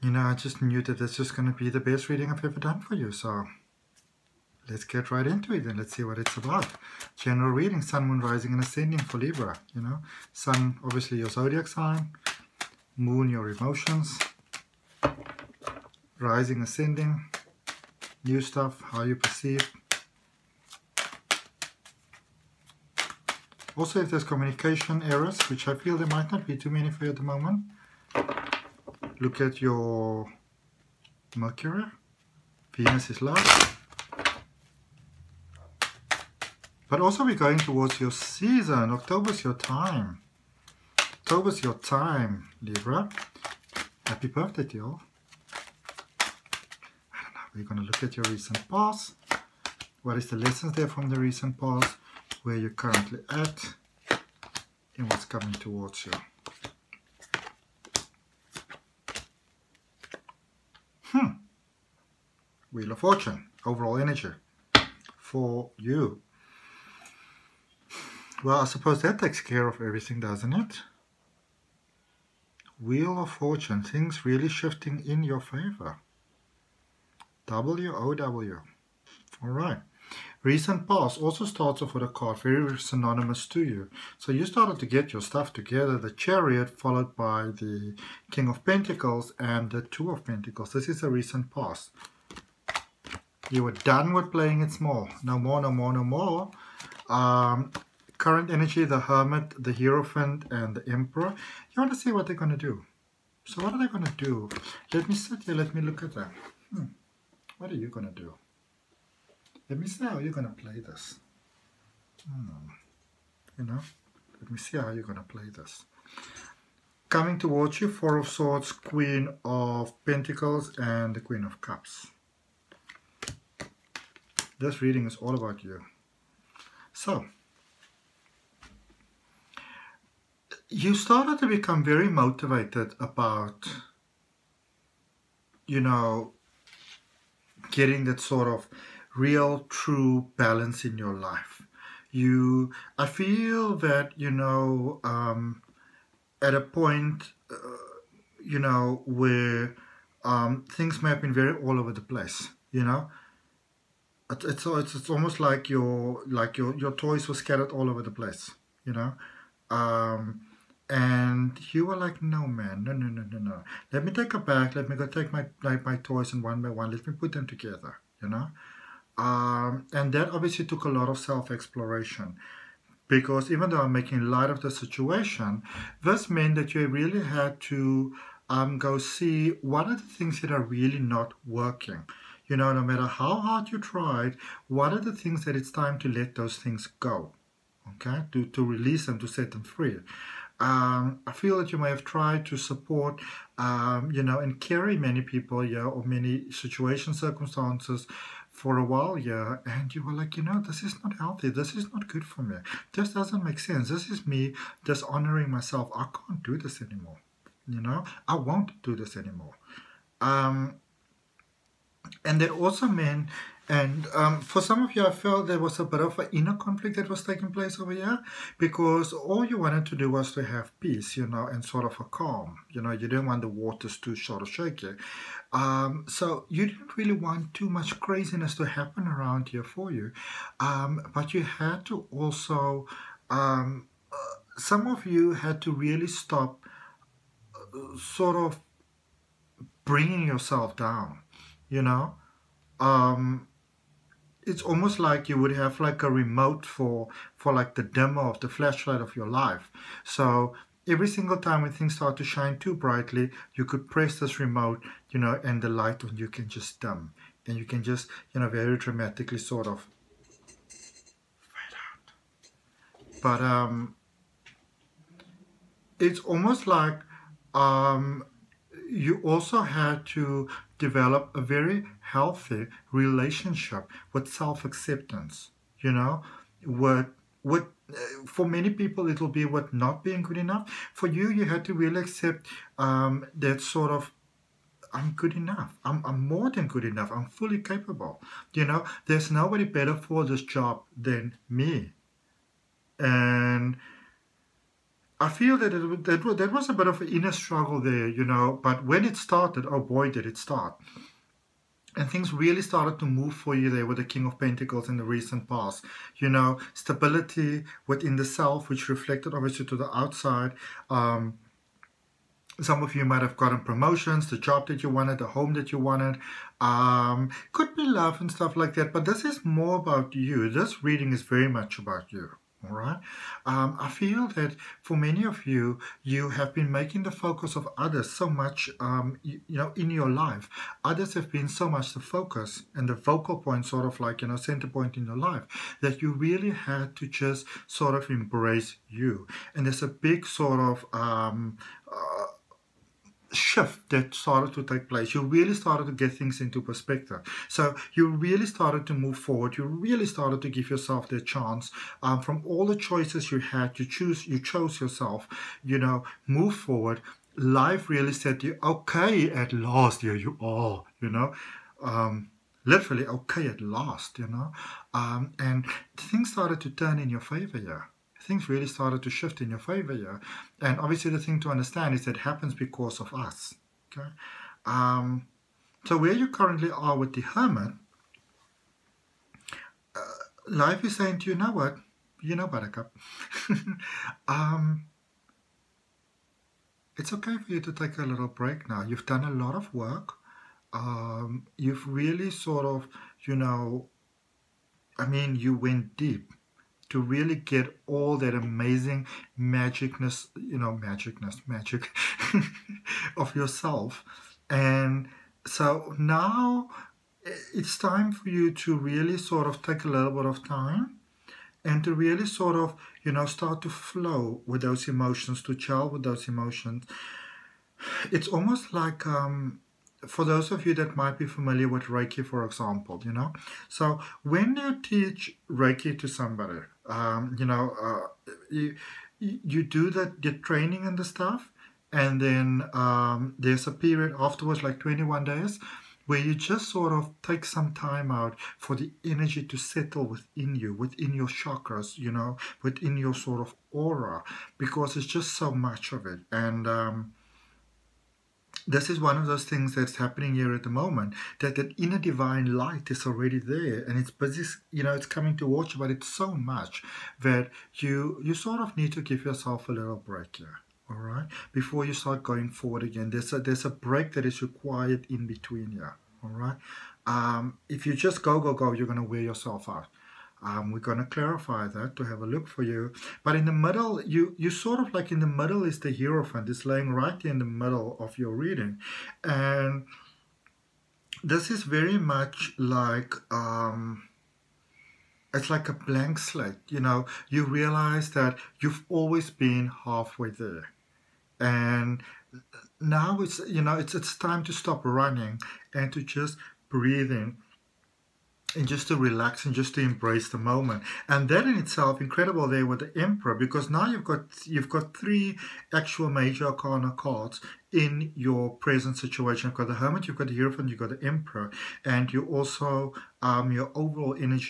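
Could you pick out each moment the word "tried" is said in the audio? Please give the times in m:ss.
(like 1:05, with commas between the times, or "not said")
3:03, 3:12.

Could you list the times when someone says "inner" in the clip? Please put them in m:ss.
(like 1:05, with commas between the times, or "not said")
3:36, 4:57, 7:31.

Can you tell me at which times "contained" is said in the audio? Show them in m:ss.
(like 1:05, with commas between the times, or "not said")
not said.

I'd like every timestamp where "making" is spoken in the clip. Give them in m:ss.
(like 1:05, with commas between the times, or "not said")
2:53, 5:26.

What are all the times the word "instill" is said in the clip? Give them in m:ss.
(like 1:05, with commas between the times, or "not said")
not said.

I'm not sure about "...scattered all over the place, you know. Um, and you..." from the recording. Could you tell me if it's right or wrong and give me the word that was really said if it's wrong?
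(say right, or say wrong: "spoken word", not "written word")
right.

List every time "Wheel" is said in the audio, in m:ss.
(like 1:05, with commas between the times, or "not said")
1:02, 1:12.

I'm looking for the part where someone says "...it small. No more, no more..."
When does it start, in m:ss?
1:34.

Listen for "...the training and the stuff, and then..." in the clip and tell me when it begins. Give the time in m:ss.
7:10.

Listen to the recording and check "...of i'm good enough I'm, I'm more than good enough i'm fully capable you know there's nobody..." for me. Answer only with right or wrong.
right.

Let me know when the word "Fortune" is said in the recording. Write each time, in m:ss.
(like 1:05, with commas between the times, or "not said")
1:02, 1:13.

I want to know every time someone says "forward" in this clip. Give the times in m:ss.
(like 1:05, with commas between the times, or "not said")
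5:49, 5:56, 7:42.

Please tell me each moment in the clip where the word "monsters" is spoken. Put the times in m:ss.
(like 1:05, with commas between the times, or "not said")
not said.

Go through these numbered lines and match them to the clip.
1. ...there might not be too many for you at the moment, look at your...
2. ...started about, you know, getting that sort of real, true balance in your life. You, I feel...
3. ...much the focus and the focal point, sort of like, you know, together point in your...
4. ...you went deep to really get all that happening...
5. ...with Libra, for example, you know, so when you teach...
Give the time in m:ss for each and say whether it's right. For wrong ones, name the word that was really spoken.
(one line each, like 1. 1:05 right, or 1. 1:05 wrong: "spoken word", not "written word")
1. 0:25 right
2. 2:12 wrong: "motivated", not "started"
3. 5:31 wrong: "center", not "together"
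4. 6:35 wrong: "amazing", not "happening"
5. 7:01 wrong: "Reiki", not "Libra".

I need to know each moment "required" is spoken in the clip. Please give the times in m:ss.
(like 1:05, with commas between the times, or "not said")
7:44.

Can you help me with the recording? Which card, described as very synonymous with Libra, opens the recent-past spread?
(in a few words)
The Chariot.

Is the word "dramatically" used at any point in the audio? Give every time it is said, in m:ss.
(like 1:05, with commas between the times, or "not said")
4:18.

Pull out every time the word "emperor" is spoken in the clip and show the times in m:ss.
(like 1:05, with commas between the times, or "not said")
1:40, 8:23, 8:31.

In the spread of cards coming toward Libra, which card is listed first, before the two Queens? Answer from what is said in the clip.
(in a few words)
Four of Swords.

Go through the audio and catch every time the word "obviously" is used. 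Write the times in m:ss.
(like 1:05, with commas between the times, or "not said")
0:10, 2:50, 5:09, 6:10.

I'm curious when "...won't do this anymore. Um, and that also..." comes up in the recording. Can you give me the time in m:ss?
3:28.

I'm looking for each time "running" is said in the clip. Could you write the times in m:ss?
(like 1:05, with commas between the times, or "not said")
8:14.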